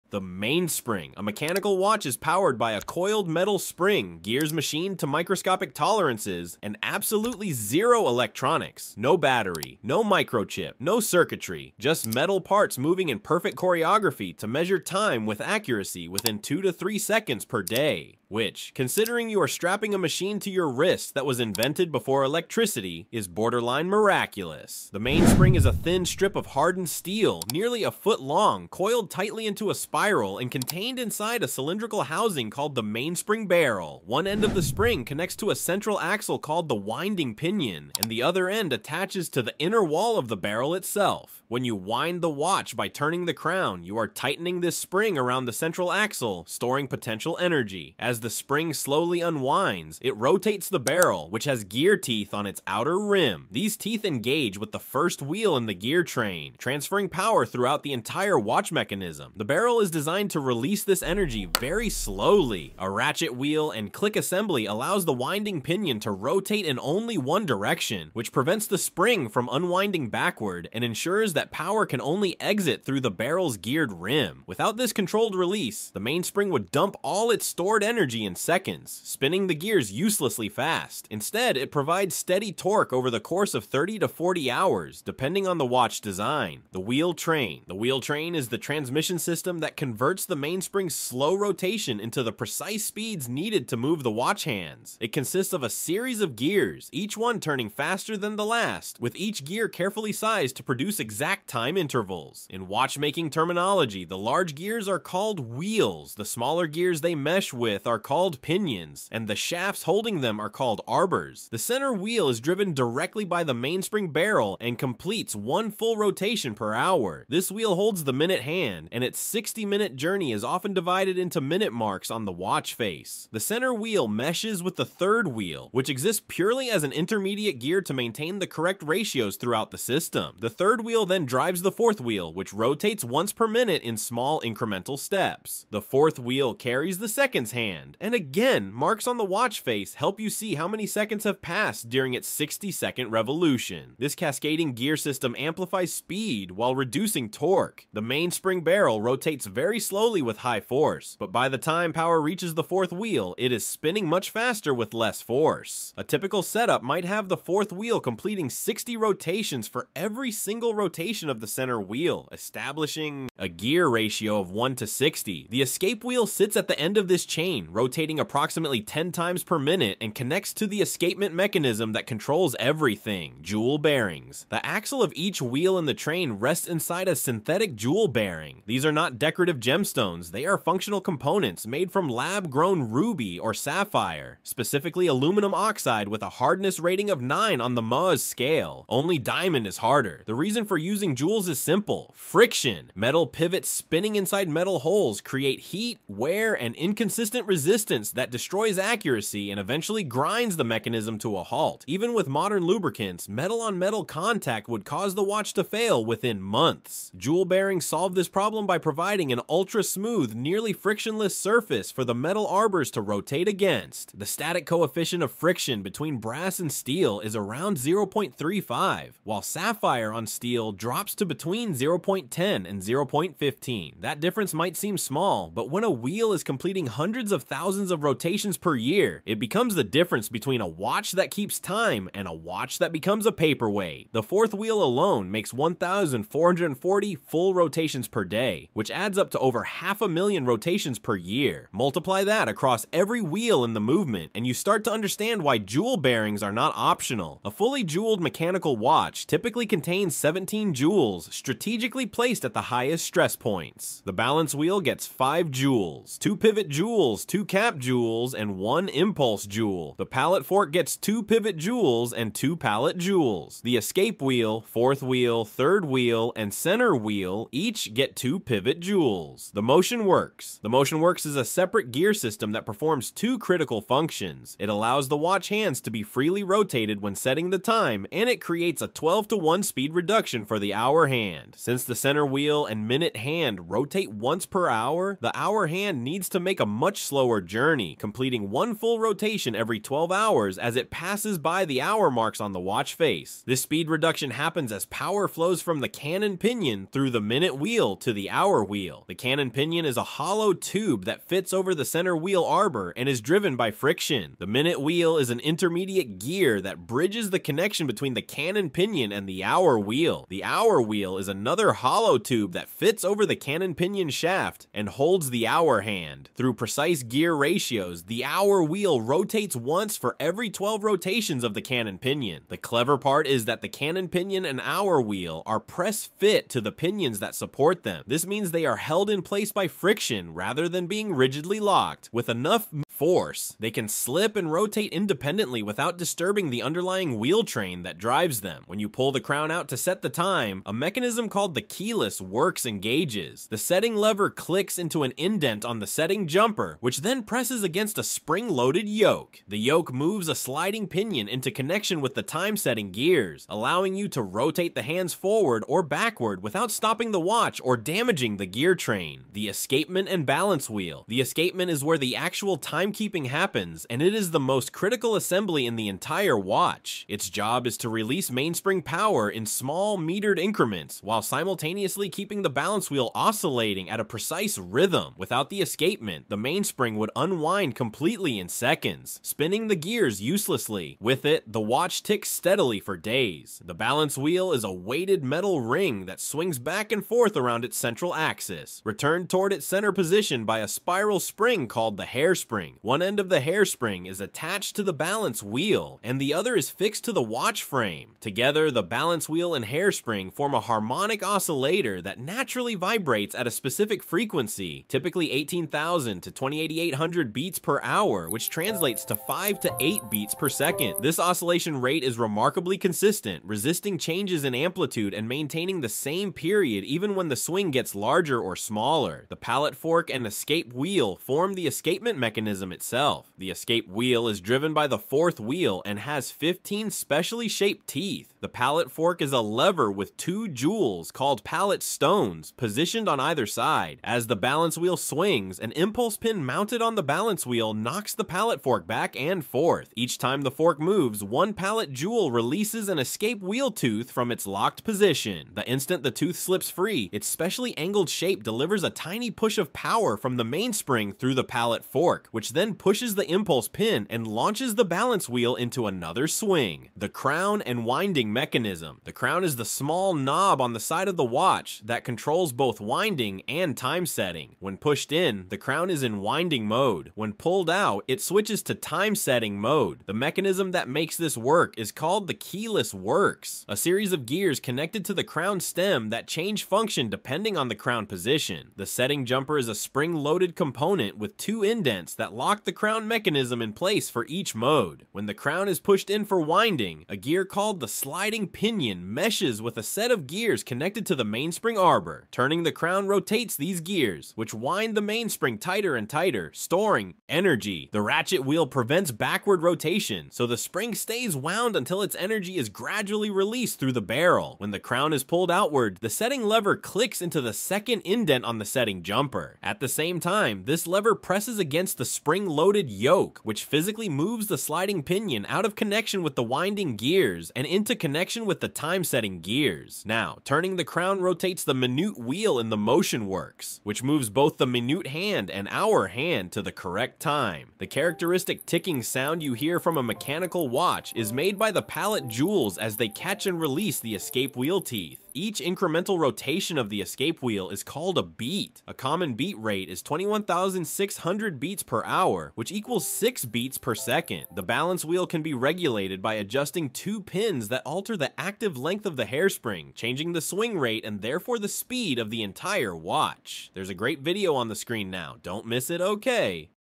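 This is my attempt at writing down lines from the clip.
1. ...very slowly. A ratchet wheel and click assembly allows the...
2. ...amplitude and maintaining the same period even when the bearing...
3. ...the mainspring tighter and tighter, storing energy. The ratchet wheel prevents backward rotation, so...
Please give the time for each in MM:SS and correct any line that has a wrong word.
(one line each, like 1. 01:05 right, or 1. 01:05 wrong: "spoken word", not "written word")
1. 01:01 right
2. 06:54 wrong: "swing", not "bearing"
3. 08:14 right.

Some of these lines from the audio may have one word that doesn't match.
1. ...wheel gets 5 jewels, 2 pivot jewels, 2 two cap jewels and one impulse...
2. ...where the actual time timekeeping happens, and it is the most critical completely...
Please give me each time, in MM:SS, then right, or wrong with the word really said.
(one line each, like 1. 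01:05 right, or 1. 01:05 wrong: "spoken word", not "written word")
1. 04:14 right
2. 06:01 wrong: "assembly", not "completely".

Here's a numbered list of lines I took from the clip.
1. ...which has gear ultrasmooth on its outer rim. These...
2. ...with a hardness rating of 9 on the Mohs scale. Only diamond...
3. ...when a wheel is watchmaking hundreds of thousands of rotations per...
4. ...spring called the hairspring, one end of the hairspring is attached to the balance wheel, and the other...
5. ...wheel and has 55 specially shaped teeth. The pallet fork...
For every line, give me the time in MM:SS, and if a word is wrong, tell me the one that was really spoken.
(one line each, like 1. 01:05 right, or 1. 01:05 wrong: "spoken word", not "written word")
1. 00:51 wrong: "teeth", not "ultrasmooth"
2. 03:06 right
3. 03:45 wrong: "completing", not "watchmaking"
4. 06:31 right
5. 07:05 wrong: "15", not "55".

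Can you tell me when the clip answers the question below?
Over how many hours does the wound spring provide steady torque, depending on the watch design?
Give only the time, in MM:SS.
01:23.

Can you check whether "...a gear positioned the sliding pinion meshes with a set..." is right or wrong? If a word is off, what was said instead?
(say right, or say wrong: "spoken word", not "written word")
wrong: "called", not "positioned".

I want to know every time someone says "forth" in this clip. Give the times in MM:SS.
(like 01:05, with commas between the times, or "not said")
06:27, 07:19.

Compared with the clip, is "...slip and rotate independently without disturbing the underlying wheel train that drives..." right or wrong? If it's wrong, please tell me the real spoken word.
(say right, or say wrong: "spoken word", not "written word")
right.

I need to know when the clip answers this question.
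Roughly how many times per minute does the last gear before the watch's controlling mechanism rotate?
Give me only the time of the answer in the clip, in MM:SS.
02:48.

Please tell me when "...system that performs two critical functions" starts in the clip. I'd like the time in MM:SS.
04:32.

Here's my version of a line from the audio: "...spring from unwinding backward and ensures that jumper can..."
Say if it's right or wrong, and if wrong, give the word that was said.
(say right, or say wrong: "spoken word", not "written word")
wrong: "power", not "jumper".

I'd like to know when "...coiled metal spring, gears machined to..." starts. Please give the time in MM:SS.
00:02.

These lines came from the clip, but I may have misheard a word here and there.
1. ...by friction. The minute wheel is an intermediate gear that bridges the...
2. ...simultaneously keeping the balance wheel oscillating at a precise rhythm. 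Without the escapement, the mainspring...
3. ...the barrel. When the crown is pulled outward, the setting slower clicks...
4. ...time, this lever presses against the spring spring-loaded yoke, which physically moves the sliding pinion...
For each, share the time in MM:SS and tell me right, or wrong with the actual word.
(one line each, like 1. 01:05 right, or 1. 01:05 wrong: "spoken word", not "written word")
1. 05:03 right
2. 06:11 right
3. 08:23 wrong: "lever", not "slower"
4. 08:30 right.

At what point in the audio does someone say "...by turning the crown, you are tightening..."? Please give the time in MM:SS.
00:42.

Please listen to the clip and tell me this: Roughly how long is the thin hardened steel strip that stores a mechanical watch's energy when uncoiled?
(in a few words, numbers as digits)
nearly a foot.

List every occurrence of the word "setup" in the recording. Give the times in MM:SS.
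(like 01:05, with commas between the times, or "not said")
02:36.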